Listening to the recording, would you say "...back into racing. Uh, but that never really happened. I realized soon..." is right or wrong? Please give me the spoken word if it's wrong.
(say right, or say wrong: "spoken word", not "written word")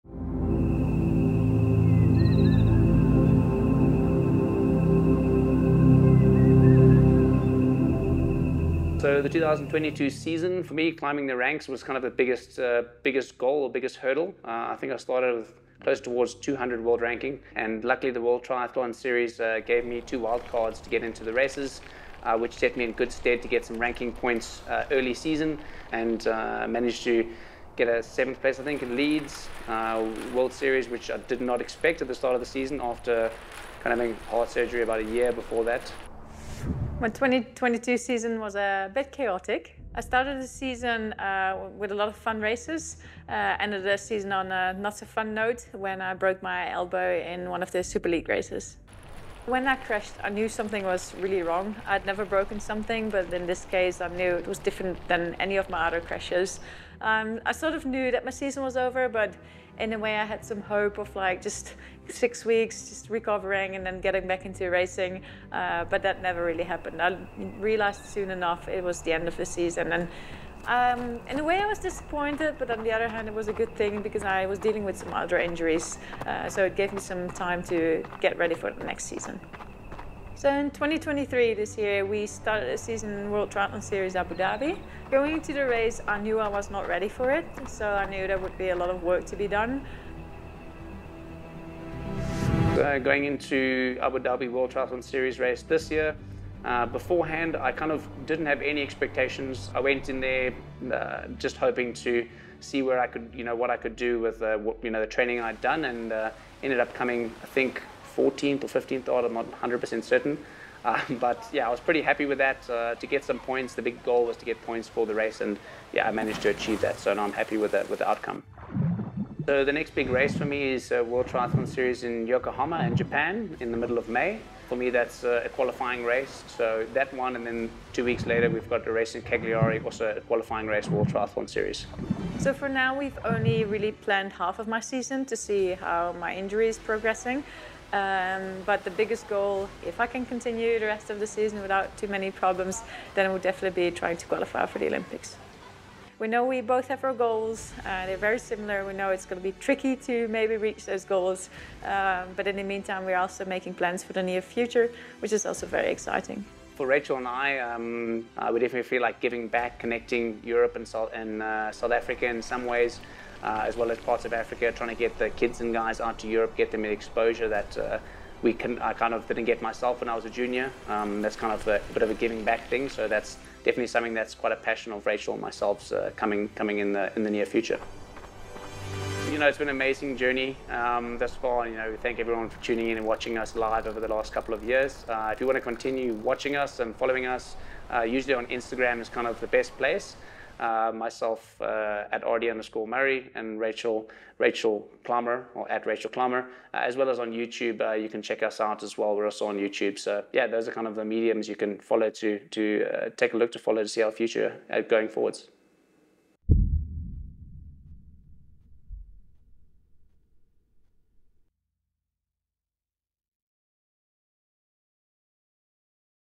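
right.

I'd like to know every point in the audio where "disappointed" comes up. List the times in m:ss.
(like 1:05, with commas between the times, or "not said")
1:11.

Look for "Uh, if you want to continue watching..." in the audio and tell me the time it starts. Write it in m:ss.
3:05.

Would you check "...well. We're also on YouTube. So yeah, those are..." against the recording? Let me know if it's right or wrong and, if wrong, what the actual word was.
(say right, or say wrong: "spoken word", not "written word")
right.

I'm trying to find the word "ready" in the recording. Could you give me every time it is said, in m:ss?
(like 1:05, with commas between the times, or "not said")
1:18, 1:26.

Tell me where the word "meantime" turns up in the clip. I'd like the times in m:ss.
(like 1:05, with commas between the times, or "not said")
2:32.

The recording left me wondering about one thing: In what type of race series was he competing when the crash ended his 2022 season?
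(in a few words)
Super League.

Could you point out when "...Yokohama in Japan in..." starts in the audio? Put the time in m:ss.
2:02.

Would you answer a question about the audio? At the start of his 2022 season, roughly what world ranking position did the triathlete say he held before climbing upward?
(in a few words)
200.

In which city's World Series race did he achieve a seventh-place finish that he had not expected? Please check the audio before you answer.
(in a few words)
Leeds.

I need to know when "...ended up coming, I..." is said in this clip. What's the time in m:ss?
1:46.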